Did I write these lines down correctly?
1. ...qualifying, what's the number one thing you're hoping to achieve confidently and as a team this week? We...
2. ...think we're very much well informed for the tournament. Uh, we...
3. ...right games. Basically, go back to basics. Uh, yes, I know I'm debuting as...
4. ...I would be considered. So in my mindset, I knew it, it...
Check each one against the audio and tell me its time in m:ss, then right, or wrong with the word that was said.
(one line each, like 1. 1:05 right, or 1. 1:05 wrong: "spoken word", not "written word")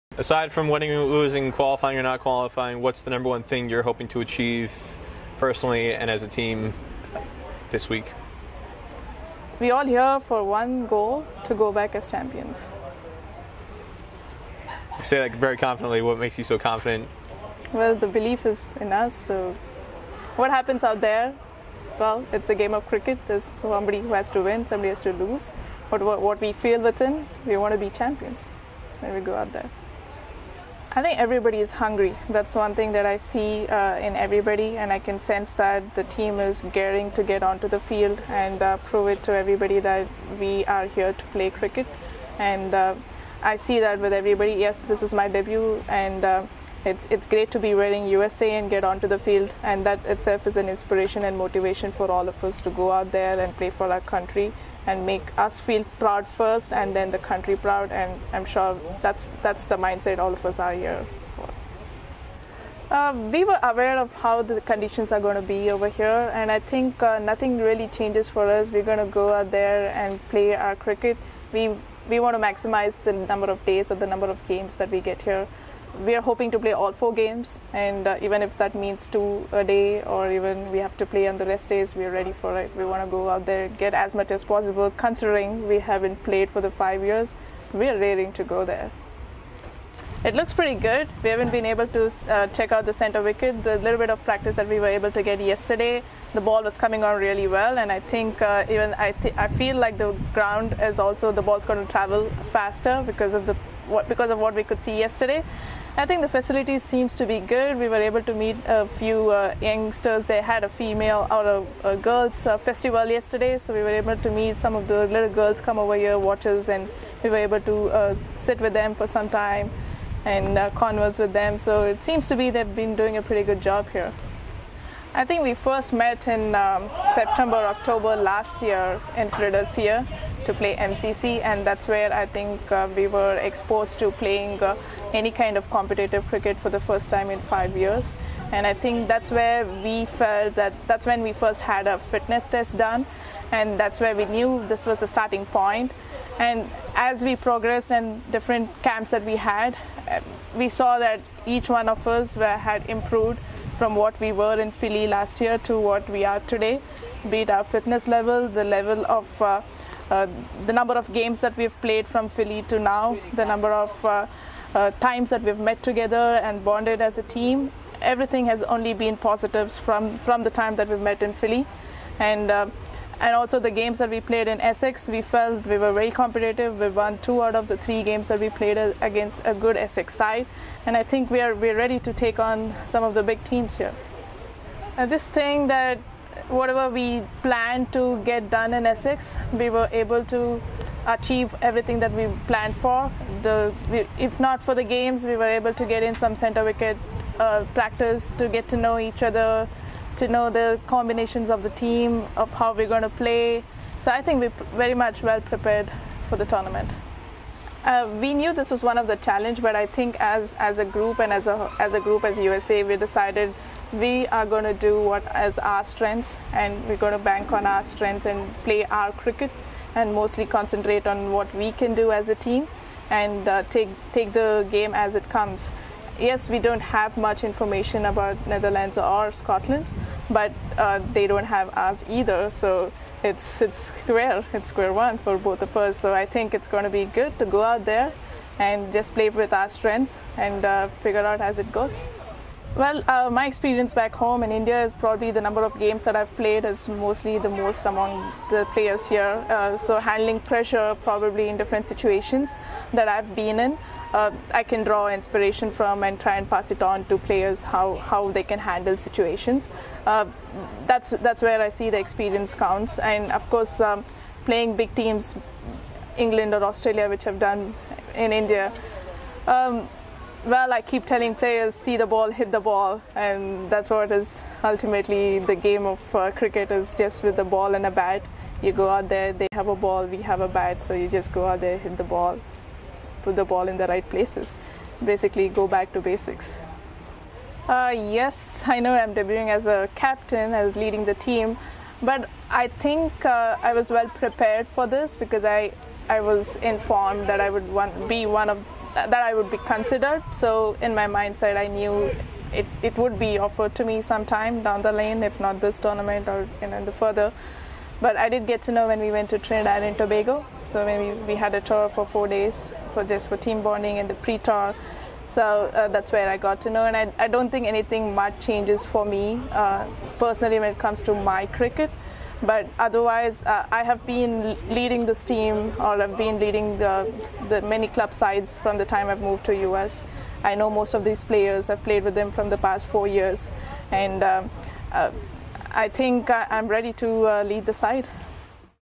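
1. 0:02 wrong: "personally", not "confidently"
2. 3:24 wrong: "prepared", not "informed"
3. 4:43 wrong: "places", not "games"
4. 4:59 right.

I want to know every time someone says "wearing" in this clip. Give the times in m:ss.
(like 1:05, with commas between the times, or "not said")
0:47.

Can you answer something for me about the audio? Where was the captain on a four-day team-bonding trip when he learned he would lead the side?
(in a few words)
Trinidad and Tobago.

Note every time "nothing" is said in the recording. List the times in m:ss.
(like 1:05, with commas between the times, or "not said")
1:07.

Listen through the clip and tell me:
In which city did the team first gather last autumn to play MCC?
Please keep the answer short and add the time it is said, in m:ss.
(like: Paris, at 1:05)
Philadelphia, at 2:09.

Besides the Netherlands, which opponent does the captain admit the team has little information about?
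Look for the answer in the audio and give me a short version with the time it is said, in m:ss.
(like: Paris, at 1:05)
Scotland, at 3:49.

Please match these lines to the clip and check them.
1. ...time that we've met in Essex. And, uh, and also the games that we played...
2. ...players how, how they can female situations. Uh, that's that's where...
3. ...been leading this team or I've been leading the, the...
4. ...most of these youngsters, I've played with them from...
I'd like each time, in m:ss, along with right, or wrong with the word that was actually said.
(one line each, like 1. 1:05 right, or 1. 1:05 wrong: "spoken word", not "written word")
1. 2:50 wrong: "Philly", not "Essex"
2. 4:17 wrong: "handle", not "female"
3. 5:24 right
4. 5:30 wrong: "players", not "youngsters".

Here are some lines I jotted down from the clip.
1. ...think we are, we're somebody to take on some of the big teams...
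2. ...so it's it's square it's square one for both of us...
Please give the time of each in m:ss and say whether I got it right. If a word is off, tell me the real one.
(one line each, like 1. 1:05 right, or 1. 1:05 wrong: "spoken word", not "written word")
1. 3:01 wrong: "ready", not "somebody"
2. 3:52 right.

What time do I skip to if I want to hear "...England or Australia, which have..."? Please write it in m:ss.
4:26.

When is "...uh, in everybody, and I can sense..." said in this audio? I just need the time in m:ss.
0:33.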